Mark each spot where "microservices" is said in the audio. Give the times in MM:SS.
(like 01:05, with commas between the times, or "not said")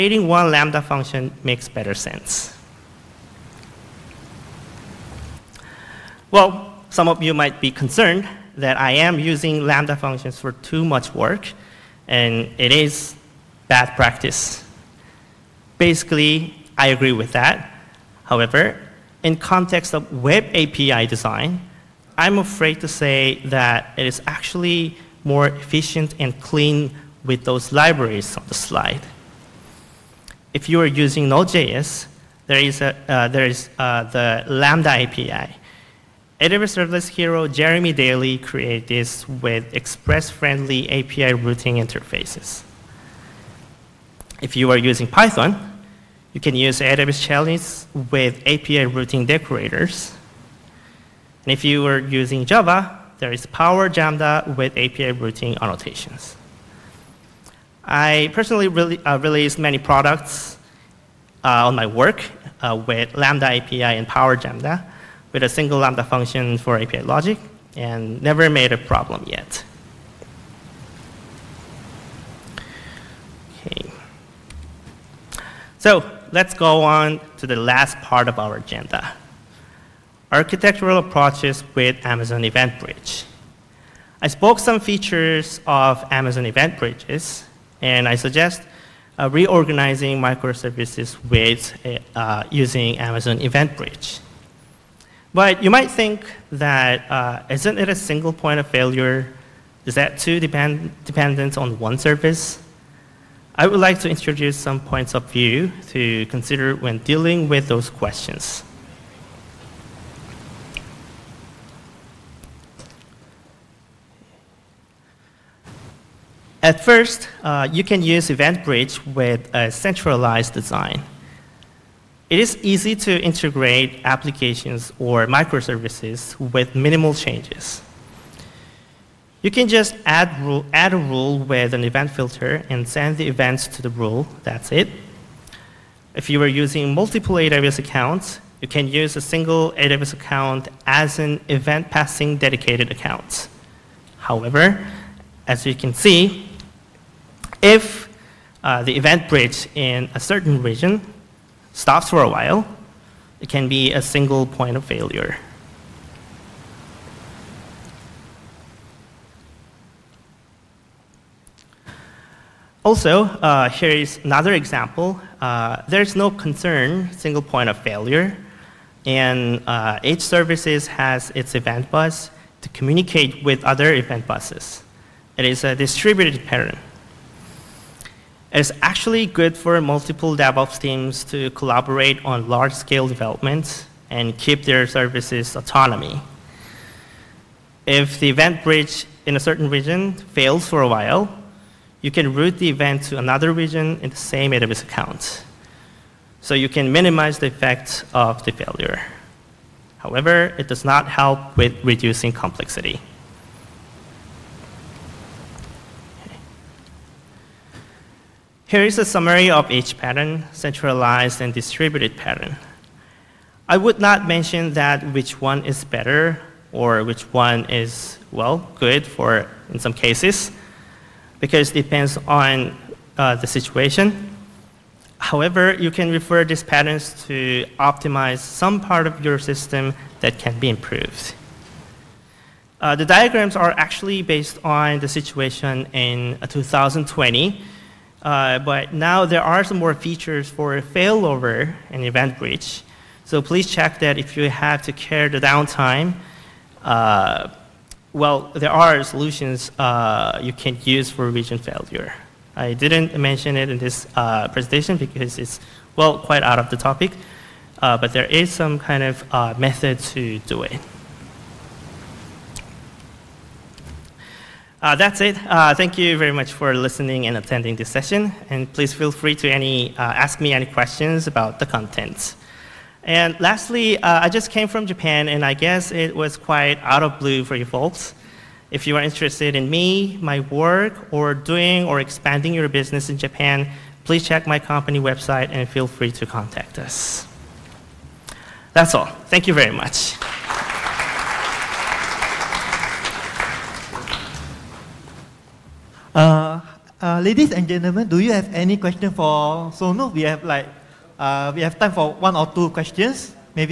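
01:30, 02:05.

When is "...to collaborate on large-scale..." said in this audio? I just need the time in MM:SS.
03:01.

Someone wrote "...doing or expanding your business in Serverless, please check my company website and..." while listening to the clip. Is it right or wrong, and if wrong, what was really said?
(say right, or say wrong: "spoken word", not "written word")
wrong: "Japan", not "Serverless".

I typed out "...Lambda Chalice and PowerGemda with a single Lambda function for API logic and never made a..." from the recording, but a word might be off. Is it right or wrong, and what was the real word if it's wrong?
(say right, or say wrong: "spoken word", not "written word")
wrong: "API", not "Chalice".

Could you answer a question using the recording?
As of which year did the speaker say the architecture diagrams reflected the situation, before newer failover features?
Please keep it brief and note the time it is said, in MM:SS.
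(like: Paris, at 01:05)
2020, at 03:56.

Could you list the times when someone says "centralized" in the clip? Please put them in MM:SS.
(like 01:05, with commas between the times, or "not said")
01:59, 03:30.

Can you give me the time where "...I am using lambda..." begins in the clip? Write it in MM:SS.
00:08.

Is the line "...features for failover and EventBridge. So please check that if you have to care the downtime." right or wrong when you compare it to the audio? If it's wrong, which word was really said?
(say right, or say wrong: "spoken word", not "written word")
right.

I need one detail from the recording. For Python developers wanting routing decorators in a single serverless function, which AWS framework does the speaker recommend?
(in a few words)
AWS Chalice.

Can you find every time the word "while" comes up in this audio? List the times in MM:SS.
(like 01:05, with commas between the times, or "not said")
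02:32, 03:10.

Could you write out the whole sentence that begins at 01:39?
Is that too depend dependent on one service?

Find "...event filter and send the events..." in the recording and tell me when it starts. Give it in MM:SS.
02:11.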